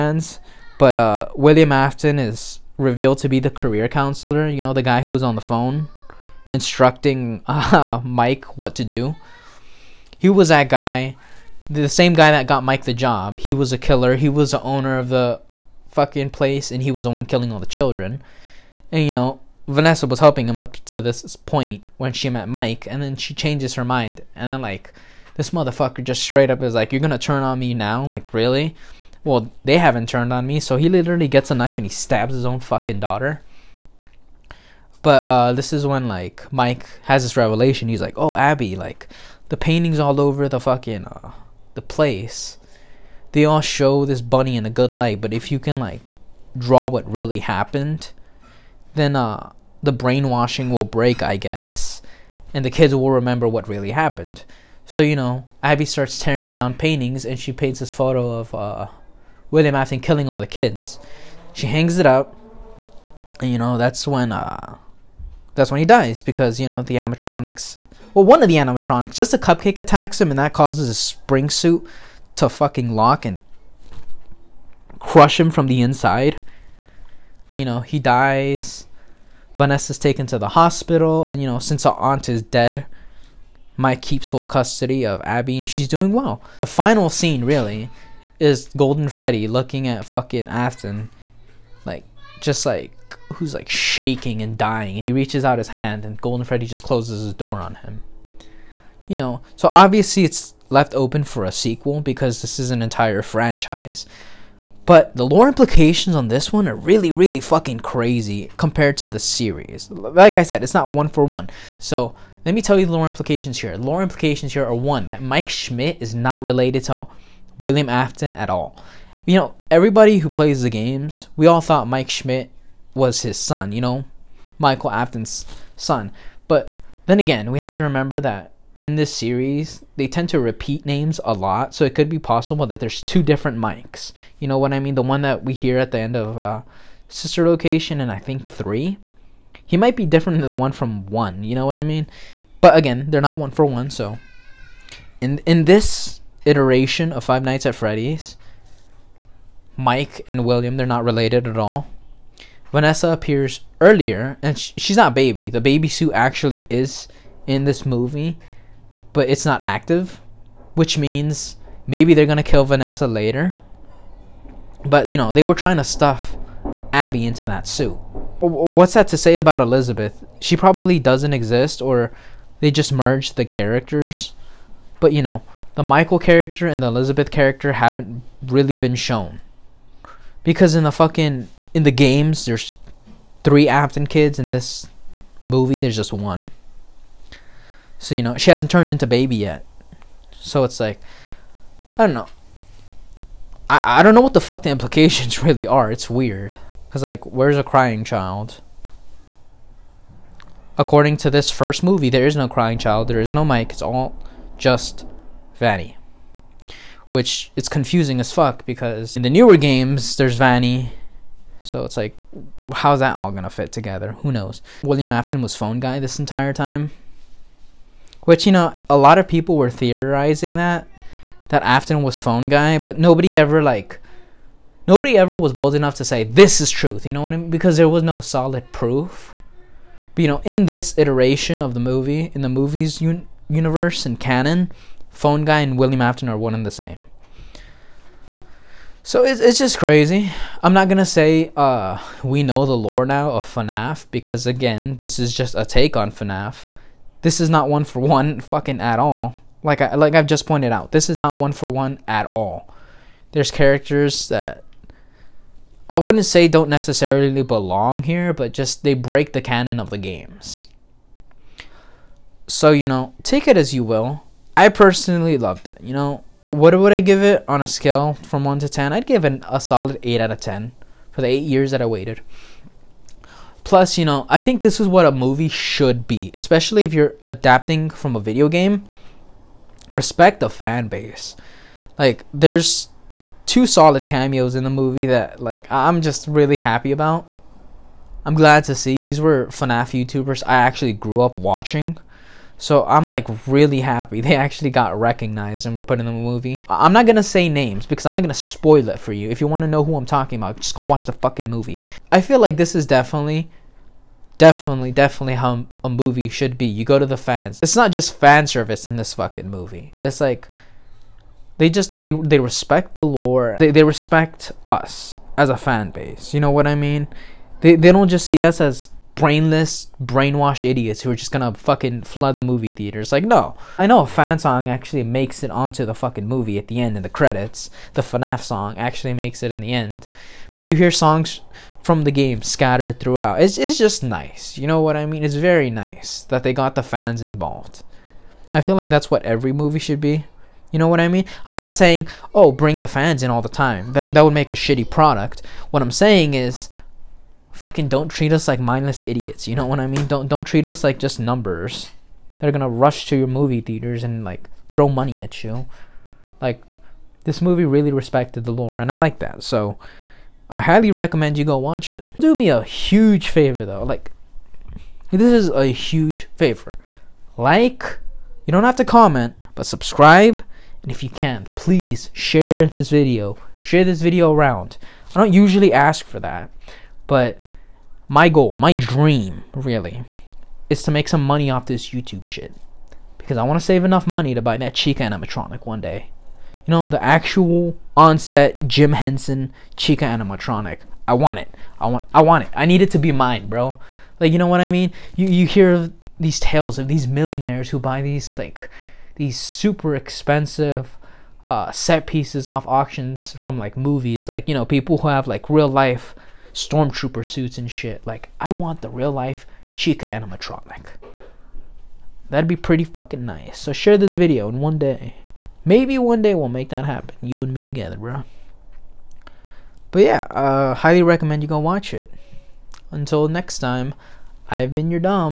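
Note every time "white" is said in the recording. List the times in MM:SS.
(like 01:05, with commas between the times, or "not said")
not said.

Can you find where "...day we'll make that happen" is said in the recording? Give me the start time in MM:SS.
06:56.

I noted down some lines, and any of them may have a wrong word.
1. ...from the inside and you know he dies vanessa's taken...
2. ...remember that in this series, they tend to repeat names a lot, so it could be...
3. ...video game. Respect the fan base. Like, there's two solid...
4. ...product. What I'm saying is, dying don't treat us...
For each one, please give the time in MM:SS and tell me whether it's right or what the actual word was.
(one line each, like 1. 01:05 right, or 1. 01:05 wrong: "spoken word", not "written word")
1. 01:15 right
2. 02:07 right
3. 04:38 right
4. 05:44 wrong: "fucking", not "dying".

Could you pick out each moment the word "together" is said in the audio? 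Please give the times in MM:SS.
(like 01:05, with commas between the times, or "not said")
03:33, 06:57.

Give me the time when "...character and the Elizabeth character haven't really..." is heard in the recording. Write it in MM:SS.
02:56.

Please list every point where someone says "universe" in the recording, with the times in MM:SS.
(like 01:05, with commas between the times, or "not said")
03:53.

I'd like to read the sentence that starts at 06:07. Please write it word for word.
Like you don't have to comment, but subscribe.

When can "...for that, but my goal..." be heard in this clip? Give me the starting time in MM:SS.
06:16.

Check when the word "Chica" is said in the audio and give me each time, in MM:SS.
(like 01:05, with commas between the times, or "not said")
06:24, 06:29, 06:49.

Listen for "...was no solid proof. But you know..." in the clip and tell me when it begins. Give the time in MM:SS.
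03:47.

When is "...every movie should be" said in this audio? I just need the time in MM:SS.
05:39.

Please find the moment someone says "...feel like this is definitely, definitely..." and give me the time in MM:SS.
05:02.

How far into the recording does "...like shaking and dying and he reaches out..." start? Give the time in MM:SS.
01:33.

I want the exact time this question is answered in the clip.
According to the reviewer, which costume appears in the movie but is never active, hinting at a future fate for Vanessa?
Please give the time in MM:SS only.
02:35.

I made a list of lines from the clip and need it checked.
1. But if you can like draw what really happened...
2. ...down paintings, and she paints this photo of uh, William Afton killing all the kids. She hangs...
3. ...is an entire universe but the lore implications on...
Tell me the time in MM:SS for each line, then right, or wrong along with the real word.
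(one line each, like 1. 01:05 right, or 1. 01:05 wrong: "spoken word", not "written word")
1. 00:45 right
2. 00:56 right
3. 01:42 wrong: "franchise", not "universe".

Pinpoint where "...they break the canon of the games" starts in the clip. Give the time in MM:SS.
04:18.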